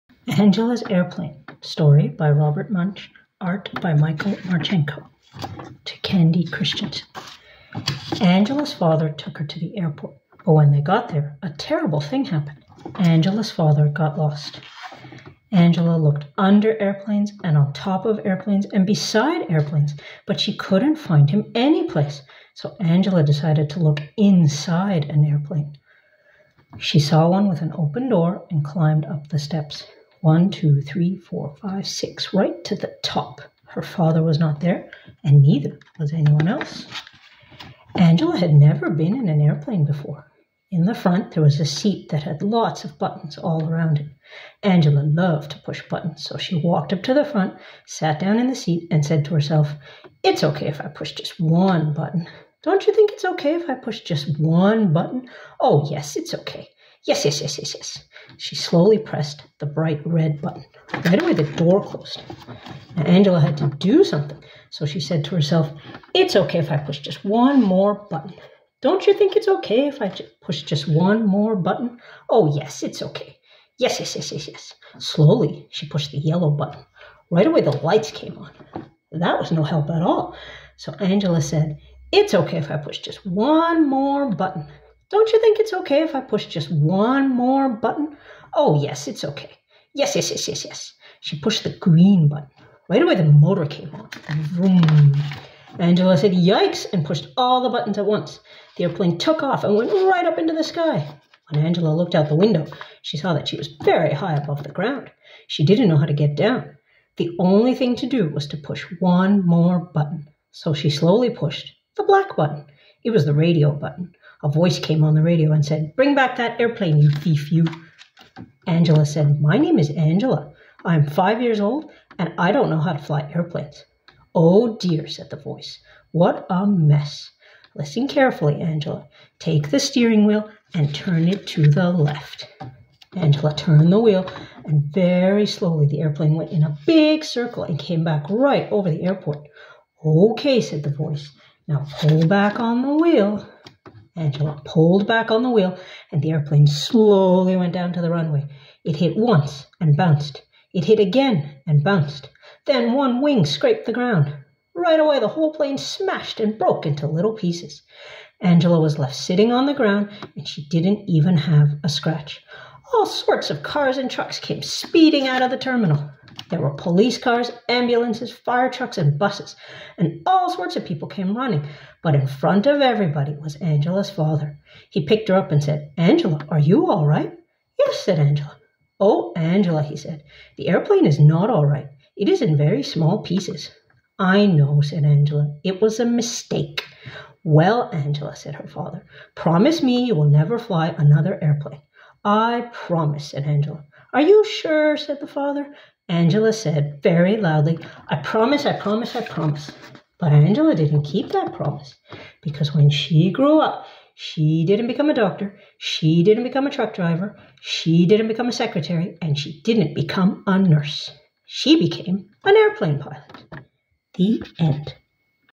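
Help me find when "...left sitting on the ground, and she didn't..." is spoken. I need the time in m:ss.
2:38.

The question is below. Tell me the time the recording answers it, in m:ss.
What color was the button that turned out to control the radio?
1:52.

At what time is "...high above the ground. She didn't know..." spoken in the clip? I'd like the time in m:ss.
1:44.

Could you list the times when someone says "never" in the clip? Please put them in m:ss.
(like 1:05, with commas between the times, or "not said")
0:38, 3:10.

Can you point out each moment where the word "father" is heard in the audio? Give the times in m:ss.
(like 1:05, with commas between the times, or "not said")
0:08, 0:13, 0:33, 2:54, 3:08, 3:15.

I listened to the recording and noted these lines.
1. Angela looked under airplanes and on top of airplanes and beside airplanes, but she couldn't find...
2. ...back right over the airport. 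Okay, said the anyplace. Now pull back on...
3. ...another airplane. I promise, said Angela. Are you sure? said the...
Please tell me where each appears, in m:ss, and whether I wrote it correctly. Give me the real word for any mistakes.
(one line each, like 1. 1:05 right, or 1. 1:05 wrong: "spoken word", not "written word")
1. 0:15 right
2. 2:18 wrong: "voice", not "anyplace"
3. 3:10 right.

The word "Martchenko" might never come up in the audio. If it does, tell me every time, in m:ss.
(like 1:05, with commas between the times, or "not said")
0:04.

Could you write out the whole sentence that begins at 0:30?
One, two, three, four, five, six, right to the top.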